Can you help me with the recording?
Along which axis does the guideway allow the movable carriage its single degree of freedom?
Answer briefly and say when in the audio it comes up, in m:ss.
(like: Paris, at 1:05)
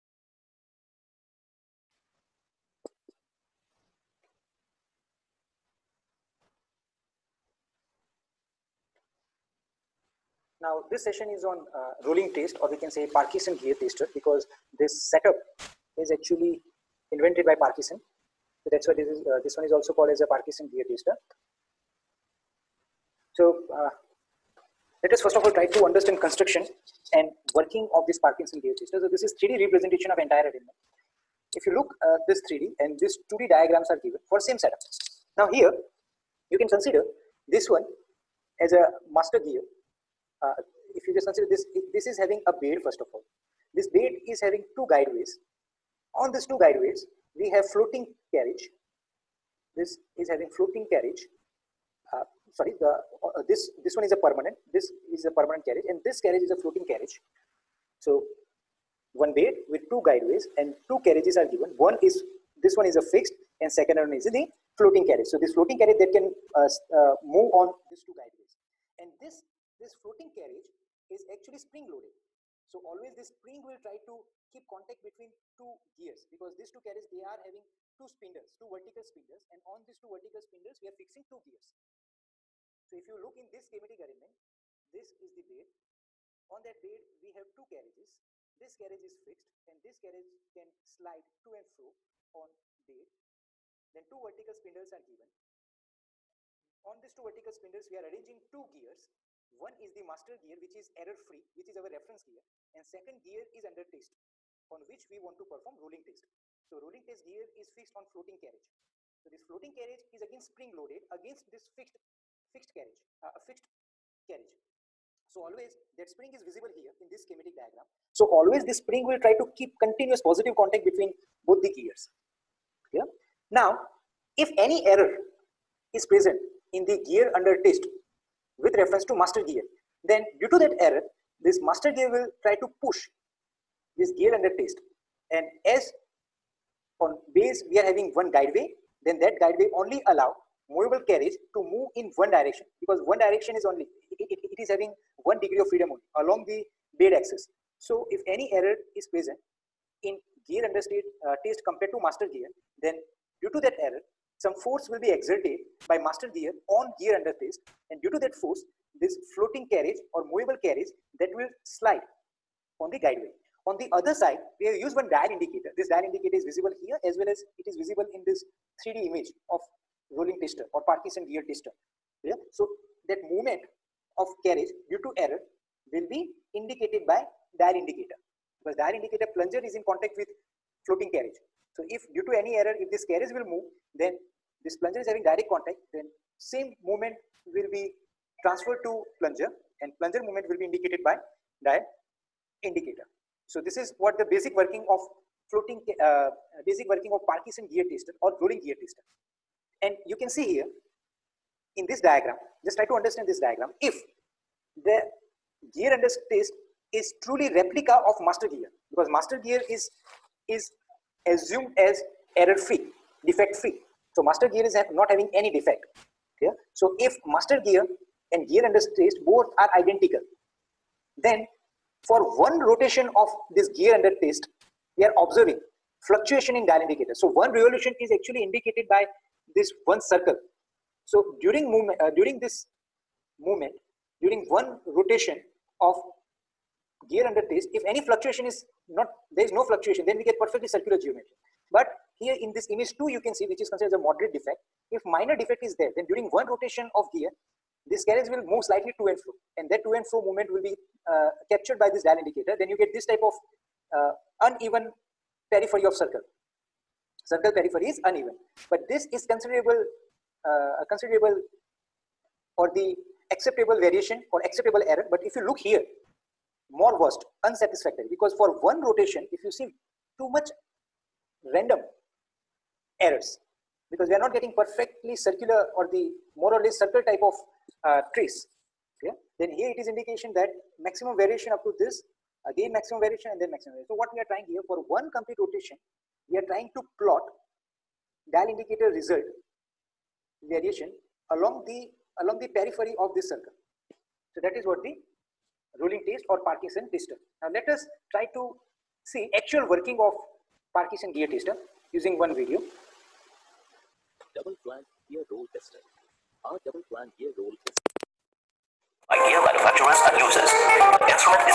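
bed axis, at 2:26.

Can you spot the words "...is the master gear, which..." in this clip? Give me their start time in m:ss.
1:39.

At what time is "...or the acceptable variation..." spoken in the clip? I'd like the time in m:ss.
4:22.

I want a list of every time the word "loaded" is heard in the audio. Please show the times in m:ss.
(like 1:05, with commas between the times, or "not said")
1:11, 1:50.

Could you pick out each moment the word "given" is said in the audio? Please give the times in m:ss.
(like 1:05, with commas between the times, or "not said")
0:34, 1:01, 1:35.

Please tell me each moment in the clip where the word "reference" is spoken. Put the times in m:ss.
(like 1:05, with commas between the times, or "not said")
1:41, 2:08.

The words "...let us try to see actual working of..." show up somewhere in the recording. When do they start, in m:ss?
4:57.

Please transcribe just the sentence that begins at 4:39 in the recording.
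Then here it is indication that maximum variation up to this again maximum variation and then maximum variation.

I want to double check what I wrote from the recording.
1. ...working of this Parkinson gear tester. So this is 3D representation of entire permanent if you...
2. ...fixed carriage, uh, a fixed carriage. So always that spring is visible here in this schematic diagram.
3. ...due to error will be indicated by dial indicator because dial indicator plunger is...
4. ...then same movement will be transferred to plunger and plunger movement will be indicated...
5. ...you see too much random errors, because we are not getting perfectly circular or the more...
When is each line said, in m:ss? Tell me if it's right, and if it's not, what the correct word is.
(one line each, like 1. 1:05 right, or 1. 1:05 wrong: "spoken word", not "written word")
1. 0:27 wrong: "element", not "permanent"
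2. 1:52 right
3. 2:54 right
4. 3:05 right
5. 4:29 right.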